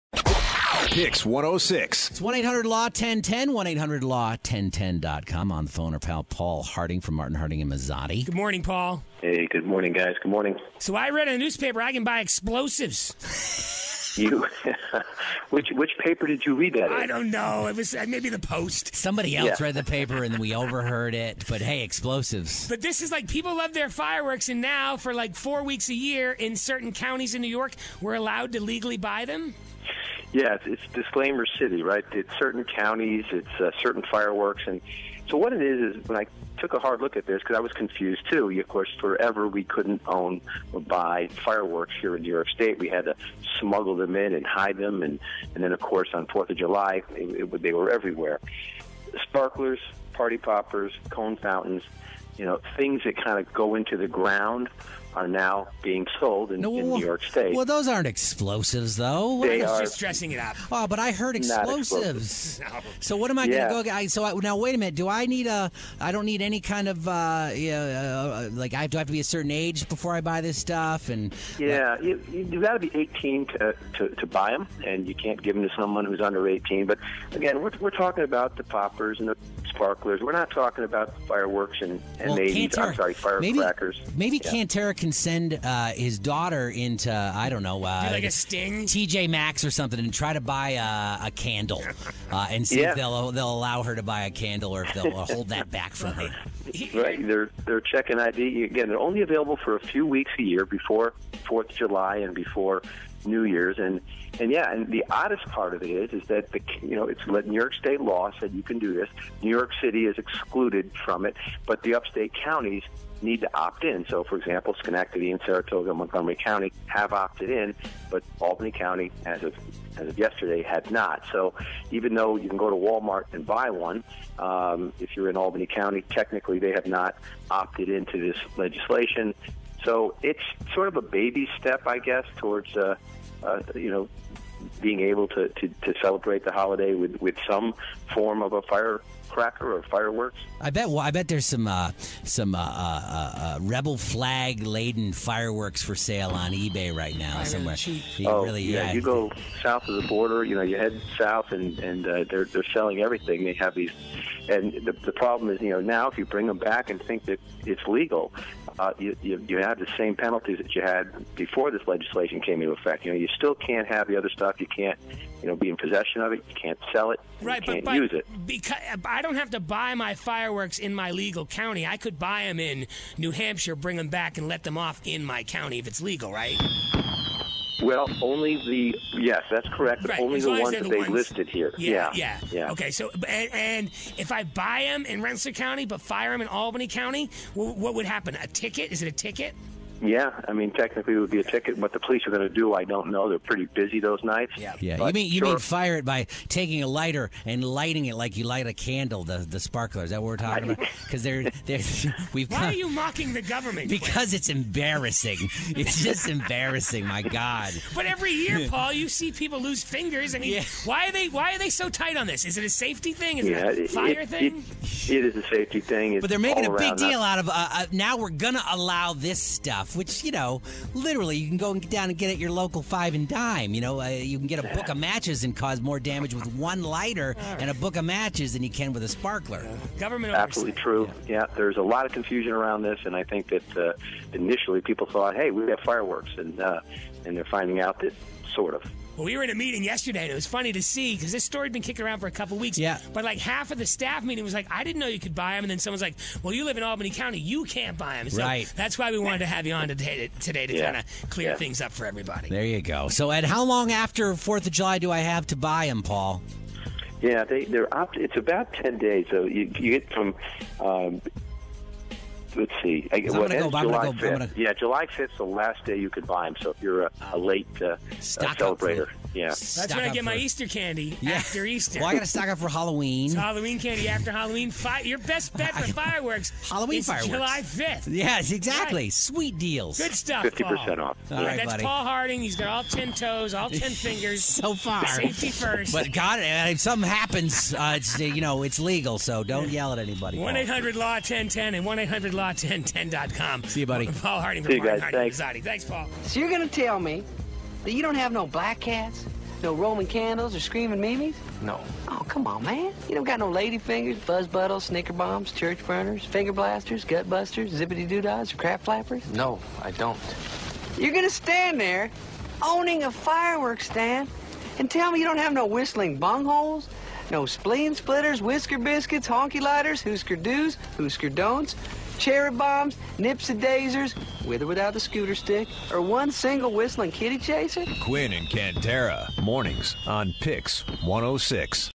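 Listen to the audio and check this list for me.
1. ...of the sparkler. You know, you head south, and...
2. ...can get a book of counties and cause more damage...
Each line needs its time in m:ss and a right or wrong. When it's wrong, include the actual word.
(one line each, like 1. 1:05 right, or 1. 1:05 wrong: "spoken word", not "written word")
1. 2:29 wrong: "border", not "sparkler"
2. 3:44 wrong: "matches", not "counties".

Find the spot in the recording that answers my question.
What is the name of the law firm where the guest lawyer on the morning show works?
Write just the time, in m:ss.
0:07.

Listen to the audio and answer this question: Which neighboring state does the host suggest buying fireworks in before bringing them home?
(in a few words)
New Hampshire.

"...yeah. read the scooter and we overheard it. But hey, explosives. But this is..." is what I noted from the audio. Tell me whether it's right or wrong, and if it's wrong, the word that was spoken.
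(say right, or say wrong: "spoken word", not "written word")
wrong: "paper", not "scooter".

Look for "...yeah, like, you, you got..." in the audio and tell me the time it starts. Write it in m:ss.
1:11.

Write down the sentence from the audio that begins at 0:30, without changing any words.
Yeah, it's, it's disclaimer city, right?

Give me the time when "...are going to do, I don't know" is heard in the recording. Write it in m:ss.
3:12.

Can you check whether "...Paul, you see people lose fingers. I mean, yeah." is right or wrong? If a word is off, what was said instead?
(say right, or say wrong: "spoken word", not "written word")
right.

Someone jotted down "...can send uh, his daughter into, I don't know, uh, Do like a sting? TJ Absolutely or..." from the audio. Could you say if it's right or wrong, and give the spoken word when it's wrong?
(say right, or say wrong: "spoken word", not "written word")
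wrong: "Maxx", not "Absolutely".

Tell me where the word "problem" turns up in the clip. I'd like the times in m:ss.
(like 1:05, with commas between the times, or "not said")
2:35.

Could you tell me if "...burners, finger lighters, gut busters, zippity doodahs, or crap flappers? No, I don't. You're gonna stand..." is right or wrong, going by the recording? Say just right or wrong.
wrong.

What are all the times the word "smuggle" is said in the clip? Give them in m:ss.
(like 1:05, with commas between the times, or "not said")
0:43.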